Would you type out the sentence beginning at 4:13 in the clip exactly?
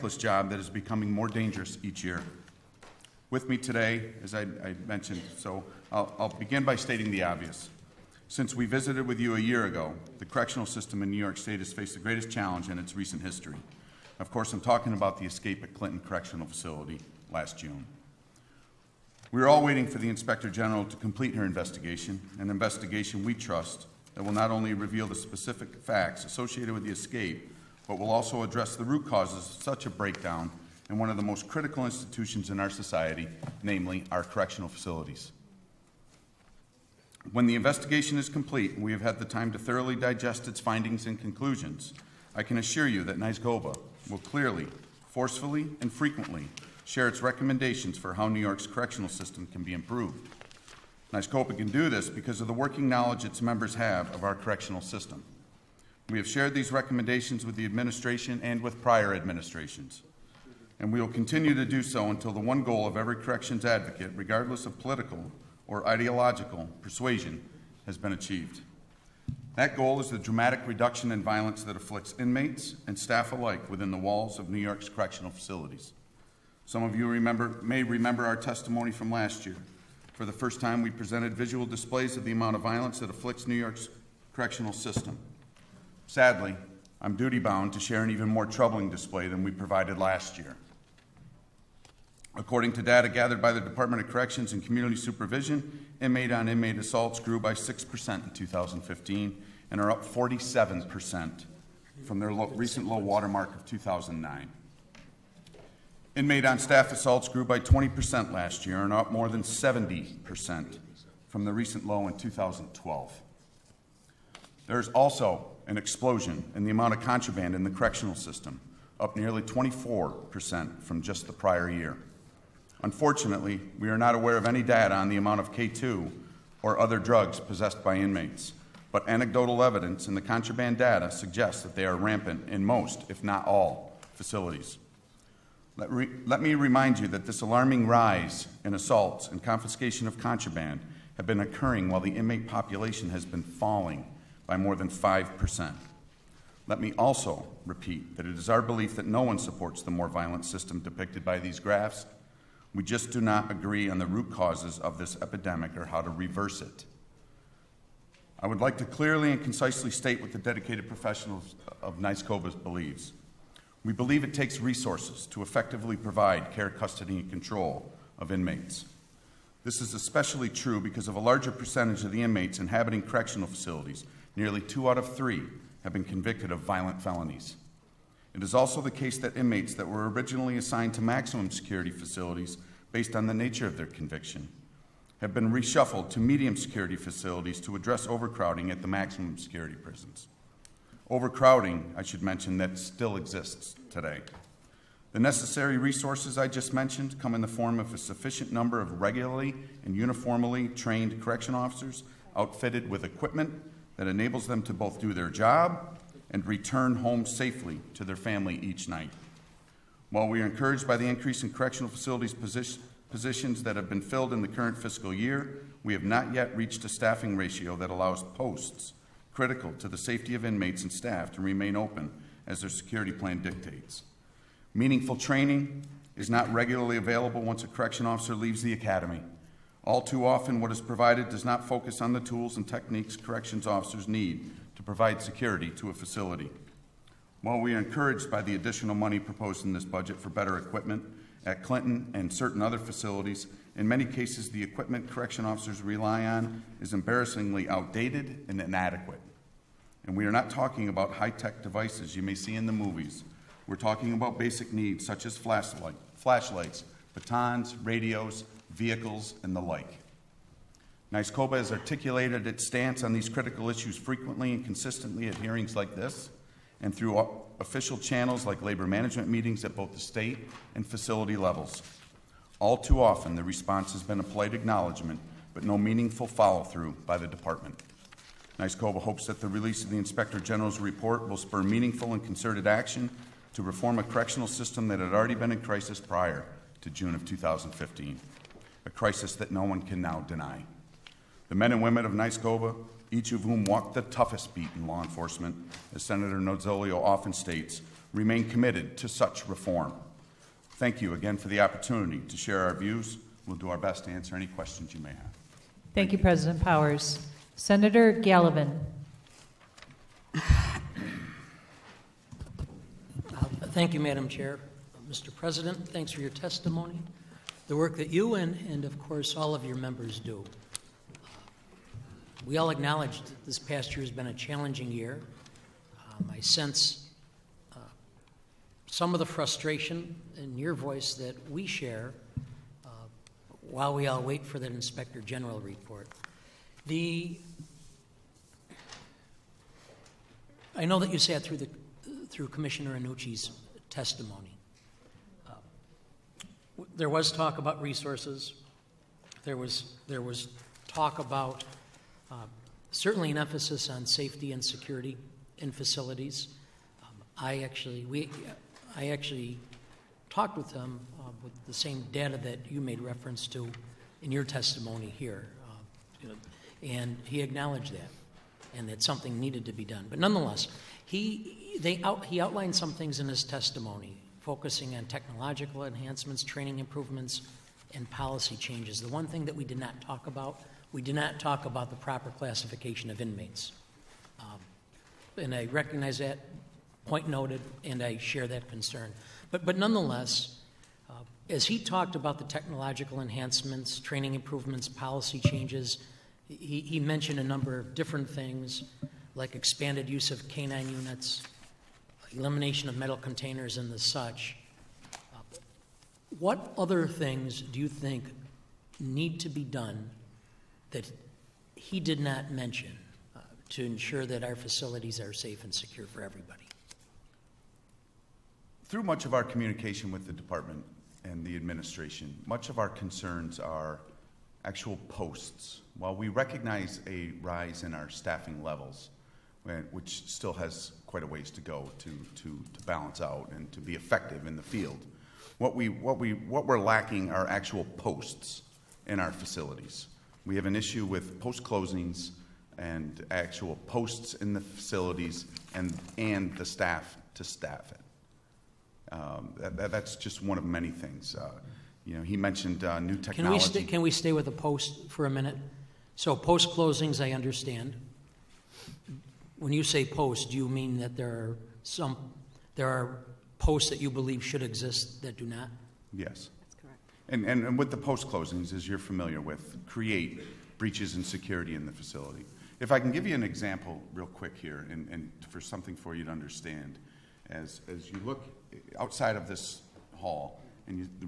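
We're talking about basic needs such as flashlight, flashlights, batons, radios, vehicles, and the like.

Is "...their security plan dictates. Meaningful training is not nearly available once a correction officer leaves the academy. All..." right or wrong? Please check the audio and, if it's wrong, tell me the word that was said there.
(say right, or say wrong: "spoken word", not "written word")
wrong: "regularly", not "nearly".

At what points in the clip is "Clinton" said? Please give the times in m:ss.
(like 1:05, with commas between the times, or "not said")
0:15, 4:01.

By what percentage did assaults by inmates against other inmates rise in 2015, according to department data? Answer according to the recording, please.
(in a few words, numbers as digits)
6%.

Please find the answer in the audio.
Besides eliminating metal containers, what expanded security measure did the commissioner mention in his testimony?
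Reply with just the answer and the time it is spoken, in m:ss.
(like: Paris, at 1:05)
canine units, at 6:40.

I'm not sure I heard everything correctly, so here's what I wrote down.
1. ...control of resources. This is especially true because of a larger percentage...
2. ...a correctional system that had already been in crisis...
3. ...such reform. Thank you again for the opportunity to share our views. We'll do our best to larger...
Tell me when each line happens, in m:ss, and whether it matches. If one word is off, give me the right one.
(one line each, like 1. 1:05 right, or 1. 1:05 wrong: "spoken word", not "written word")
1. 2:47 wrong: "inmates", not "resources"
2. 4:43 right
3. 4:59 wrong: "answer", not "larger".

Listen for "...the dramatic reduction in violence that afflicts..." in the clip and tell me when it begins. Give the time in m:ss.
1:10.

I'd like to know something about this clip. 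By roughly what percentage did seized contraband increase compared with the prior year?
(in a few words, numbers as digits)
24%.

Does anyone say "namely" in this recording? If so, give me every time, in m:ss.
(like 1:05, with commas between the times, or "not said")
0:33.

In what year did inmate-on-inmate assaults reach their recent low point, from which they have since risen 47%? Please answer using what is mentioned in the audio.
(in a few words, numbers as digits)
2009.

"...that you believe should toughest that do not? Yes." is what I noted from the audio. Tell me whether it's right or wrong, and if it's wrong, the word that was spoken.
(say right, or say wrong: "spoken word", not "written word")
wrong: "exist", not "toughest".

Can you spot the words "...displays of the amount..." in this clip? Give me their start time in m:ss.
1:21.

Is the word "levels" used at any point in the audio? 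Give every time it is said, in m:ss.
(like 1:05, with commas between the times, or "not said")
4:31, 7:08.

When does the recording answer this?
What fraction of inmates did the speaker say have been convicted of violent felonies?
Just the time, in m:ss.
2:54.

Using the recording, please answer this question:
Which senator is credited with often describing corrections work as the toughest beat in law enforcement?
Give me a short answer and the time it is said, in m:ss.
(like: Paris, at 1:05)
Senator Nozzolio, at 4:56.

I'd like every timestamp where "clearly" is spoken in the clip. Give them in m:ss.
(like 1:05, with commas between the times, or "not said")
0:44, 2:38.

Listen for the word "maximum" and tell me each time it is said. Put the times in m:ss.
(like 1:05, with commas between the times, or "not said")
3:01, 3:08.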